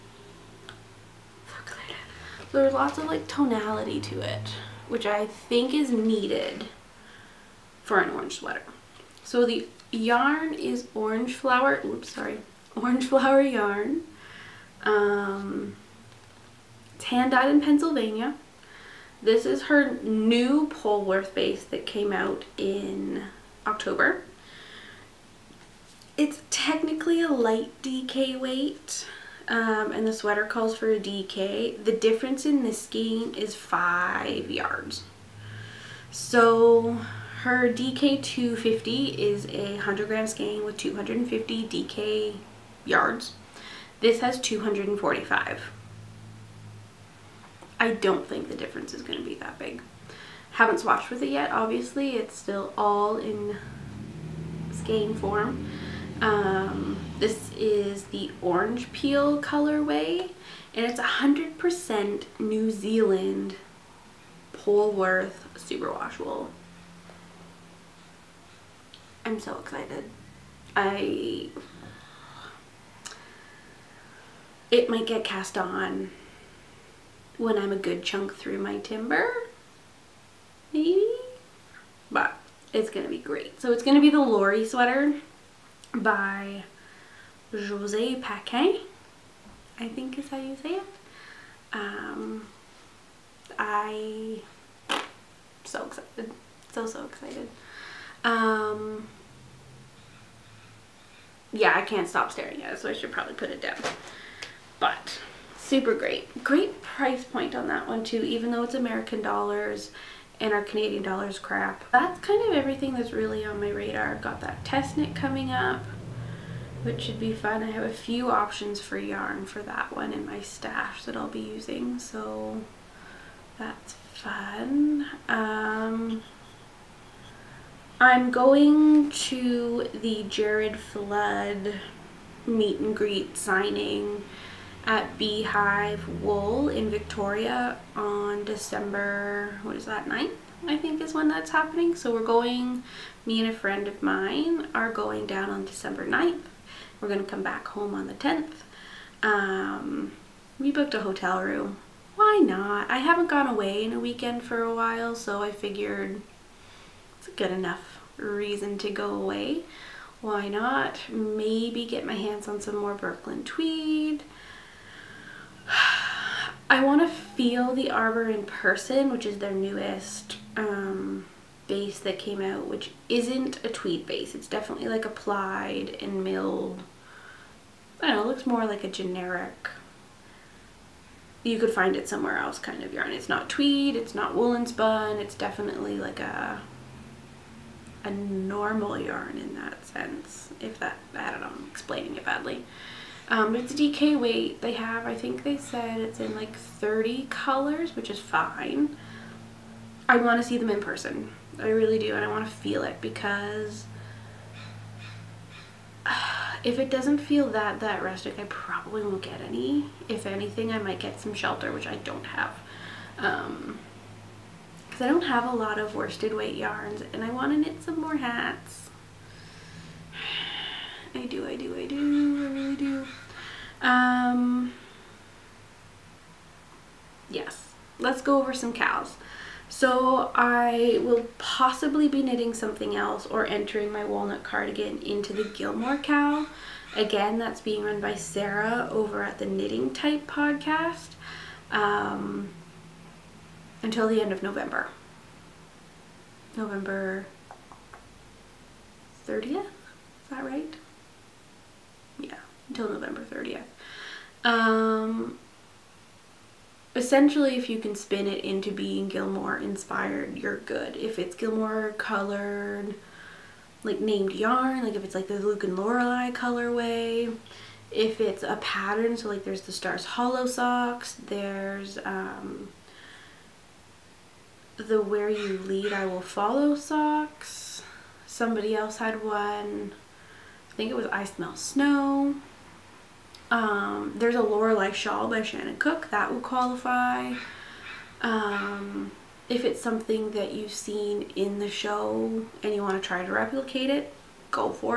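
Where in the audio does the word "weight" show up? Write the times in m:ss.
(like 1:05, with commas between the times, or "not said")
0:28, 3:14, 3:36.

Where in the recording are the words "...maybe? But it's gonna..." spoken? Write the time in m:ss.
1:20.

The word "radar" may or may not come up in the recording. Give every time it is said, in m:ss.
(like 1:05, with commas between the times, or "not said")
1:53.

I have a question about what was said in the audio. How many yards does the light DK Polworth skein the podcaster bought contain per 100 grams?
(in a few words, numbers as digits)
245.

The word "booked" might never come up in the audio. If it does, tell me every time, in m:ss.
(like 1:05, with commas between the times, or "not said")
2:30.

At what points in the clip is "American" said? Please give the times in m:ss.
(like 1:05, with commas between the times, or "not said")
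1:48.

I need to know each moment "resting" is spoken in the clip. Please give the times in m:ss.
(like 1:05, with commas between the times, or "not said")
not said.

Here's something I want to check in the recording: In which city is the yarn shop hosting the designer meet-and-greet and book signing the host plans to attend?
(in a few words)
Victoria.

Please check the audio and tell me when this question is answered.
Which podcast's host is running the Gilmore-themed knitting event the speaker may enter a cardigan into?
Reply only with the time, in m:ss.
3:59.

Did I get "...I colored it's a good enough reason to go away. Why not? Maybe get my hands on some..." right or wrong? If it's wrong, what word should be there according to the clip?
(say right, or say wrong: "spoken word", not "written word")
wrong: "figured", not "colored".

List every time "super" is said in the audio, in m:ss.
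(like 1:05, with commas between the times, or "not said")
1:05, 1:45.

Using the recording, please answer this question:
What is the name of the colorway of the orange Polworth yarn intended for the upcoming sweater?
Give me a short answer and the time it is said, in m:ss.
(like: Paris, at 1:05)
orange peel, at 0:58.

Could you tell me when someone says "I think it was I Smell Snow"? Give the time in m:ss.
4:40.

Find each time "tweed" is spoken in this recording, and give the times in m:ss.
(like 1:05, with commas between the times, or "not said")
2:43, 2:53, 3:03.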